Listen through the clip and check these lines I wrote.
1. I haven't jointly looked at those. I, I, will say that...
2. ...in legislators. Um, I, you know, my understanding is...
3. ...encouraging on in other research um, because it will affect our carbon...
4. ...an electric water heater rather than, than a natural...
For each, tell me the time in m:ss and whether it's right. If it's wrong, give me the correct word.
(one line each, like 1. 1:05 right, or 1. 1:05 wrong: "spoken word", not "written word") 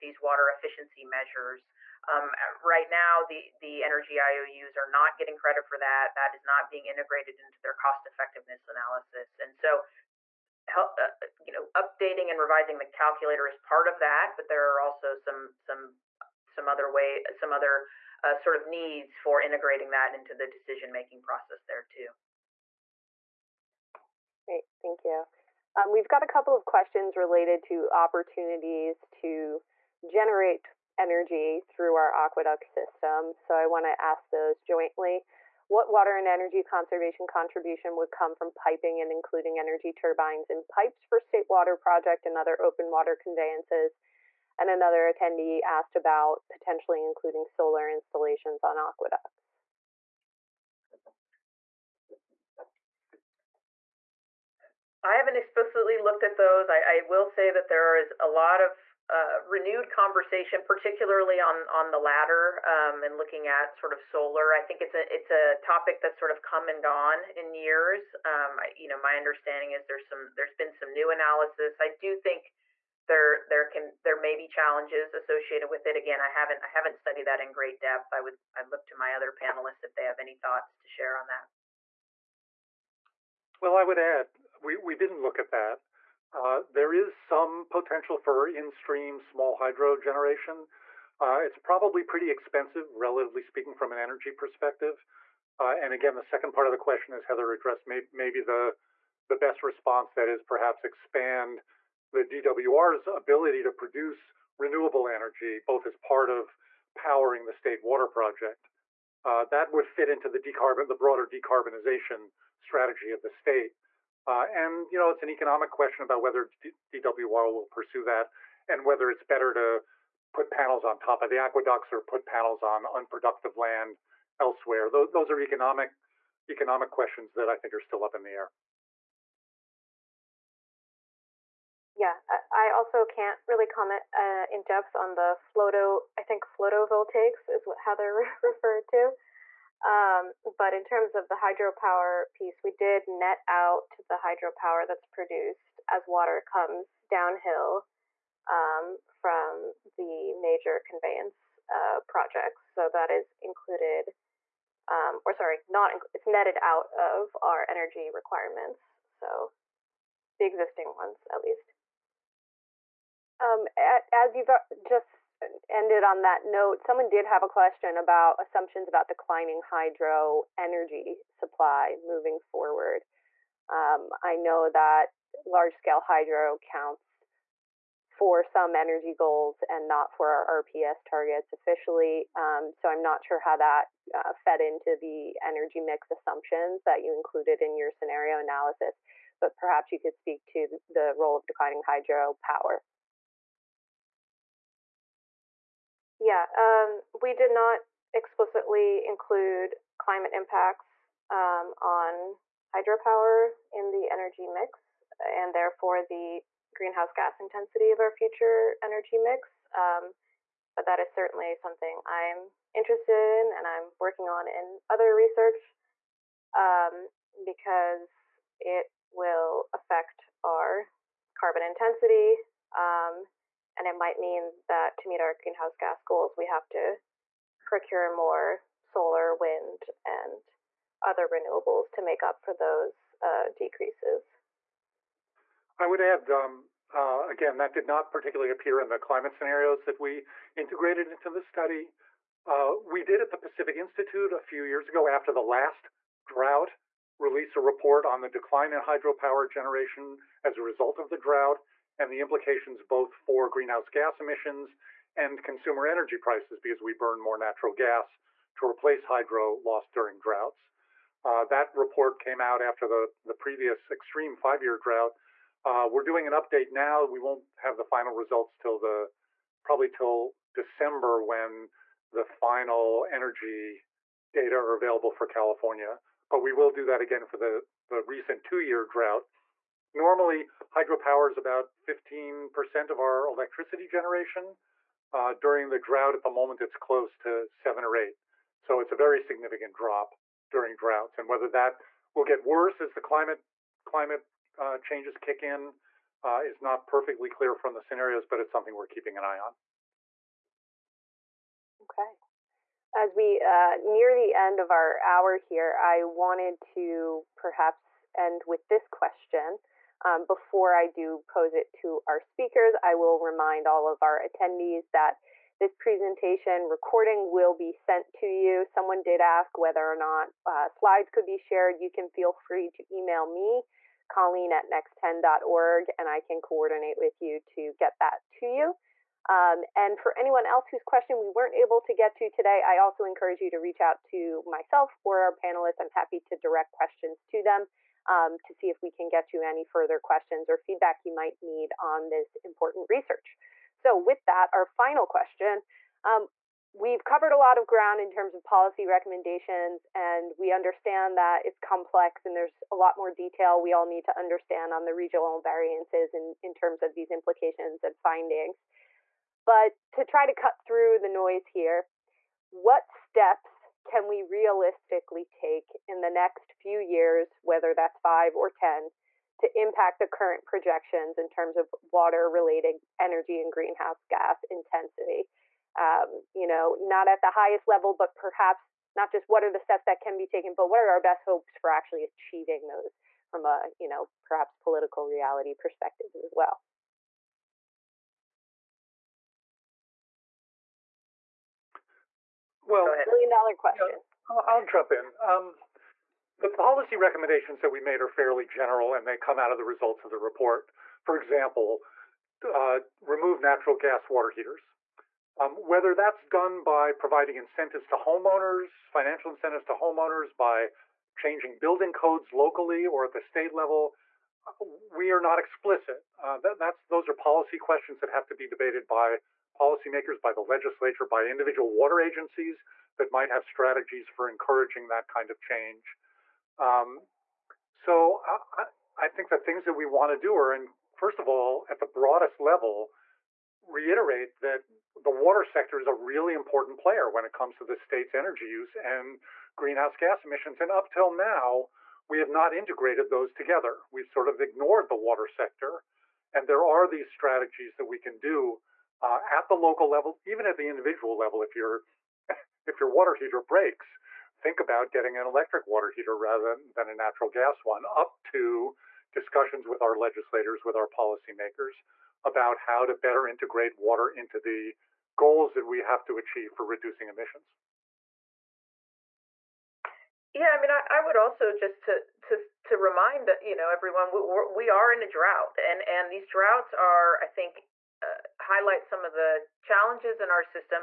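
1. 0:55 wrong: "explicitly", not "jointly"
2. 1:07 wrong: "years", not "legislators"
3. 3:33 wrong: "working", not "encouraging"
4. 7:35 right.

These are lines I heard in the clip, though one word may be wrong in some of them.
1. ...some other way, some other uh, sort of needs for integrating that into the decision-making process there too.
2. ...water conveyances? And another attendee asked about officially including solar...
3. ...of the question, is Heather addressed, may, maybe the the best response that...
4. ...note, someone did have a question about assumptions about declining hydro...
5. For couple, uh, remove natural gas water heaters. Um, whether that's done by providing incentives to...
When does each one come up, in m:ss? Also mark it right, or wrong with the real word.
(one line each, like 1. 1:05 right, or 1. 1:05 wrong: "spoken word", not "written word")
1. 0:16 right
2. 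0:42 wrong: "potentially", not "officially"
3. 1:36 right
4. 2:46 right
5. 6:41 wrong: "example", not "couple".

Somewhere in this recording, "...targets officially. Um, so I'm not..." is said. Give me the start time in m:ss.
3:01.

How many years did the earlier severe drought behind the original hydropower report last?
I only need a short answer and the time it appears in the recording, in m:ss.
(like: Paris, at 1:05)
5 years, at 4:24.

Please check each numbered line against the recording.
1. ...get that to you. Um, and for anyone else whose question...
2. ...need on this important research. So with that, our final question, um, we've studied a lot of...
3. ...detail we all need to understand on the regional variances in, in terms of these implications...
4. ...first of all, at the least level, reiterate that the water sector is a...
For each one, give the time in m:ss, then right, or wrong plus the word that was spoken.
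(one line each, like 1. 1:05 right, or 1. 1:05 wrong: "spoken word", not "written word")
1. 5:27 right
2. 5:41 wrong: "covered", not "studied"
3. 5:53 right
4. 7:10 wrong: "broadest", not "least".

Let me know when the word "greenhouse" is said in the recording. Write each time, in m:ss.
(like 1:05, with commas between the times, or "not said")
3:26, 3:45, 4:13, 6:13, 7:19.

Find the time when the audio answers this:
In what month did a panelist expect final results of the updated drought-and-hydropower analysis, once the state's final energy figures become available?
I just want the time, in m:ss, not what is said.
4:30.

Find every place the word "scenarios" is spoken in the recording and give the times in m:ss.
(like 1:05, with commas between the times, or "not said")
3:07, 3:59, 4:57.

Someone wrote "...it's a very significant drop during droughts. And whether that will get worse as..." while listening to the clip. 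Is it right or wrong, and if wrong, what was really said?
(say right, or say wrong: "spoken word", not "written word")
right.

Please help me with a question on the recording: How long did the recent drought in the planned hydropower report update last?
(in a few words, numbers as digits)
2 years.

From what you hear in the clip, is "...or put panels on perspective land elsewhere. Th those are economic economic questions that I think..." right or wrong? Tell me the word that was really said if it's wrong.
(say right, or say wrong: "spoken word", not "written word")
wrong: "unproductive", not "perspective".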